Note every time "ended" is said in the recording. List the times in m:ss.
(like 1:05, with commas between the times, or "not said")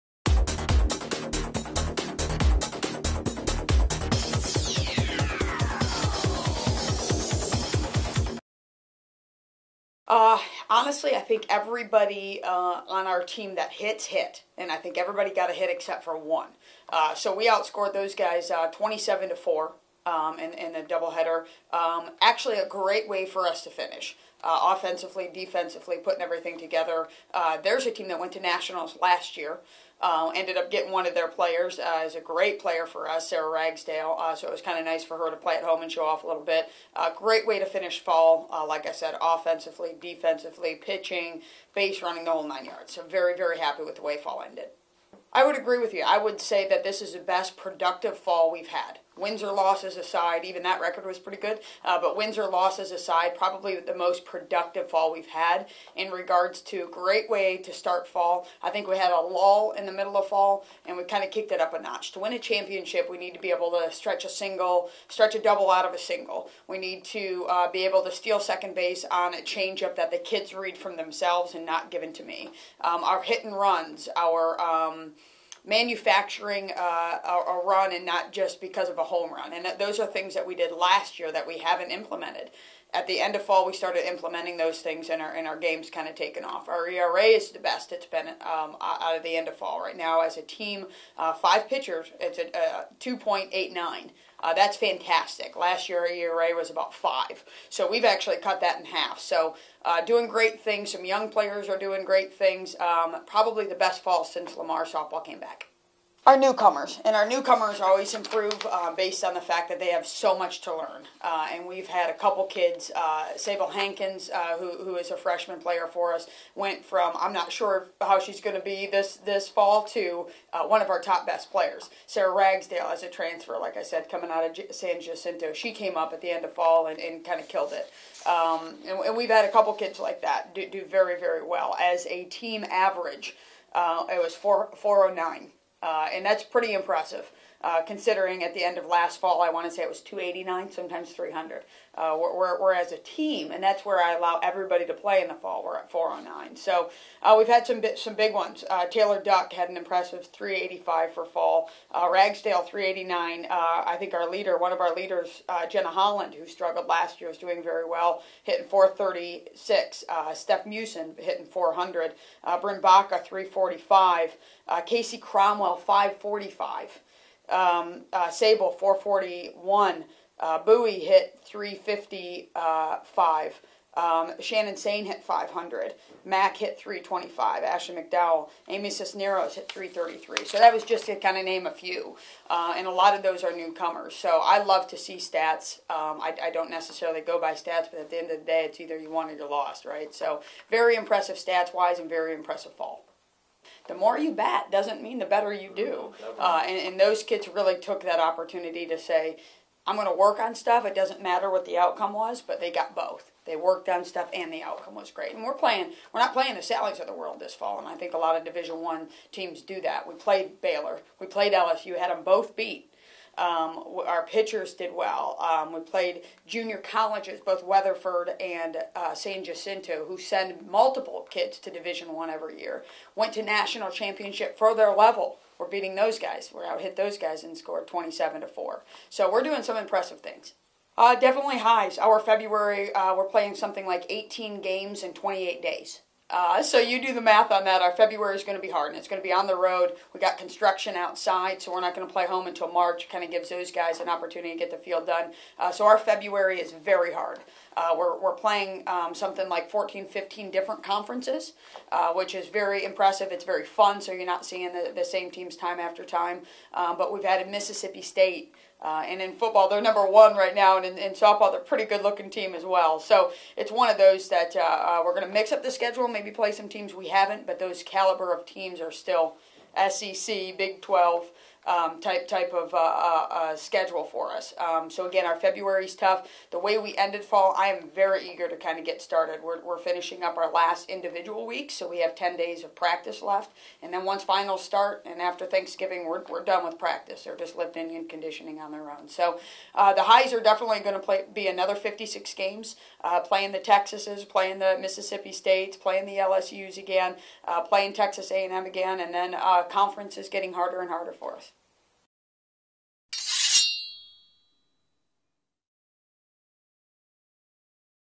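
0:30, 0:44, 4:36.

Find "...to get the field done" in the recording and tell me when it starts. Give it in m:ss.
4:04.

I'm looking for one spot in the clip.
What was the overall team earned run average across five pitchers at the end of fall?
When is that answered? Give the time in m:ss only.
1:32.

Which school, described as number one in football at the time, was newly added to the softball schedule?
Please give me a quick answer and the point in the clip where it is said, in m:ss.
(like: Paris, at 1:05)
Mississippi State, at 4:17.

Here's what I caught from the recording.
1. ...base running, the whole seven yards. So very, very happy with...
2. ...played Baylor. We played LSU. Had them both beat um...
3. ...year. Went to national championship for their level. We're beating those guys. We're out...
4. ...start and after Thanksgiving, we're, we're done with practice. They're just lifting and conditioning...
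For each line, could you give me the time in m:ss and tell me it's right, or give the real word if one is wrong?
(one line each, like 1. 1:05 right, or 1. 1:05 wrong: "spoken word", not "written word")
1. 0:41 wrong: "nine", not "seven"
2. 3:30 right
3. 3:42 right
4. 4:44 right.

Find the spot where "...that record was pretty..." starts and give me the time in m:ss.
0:50.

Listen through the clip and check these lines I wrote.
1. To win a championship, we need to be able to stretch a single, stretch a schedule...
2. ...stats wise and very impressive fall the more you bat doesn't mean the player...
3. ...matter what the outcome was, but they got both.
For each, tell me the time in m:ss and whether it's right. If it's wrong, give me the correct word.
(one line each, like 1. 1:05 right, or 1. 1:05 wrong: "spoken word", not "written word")
1. 1:02 wrong: "double", not "schedule"
2. 3:11 wrong: "better", not "player"
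3. 3:21 right.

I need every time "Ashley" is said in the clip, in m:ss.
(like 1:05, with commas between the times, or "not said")
2:57.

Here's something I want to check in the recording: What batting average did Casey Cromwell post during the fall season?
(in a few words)
545.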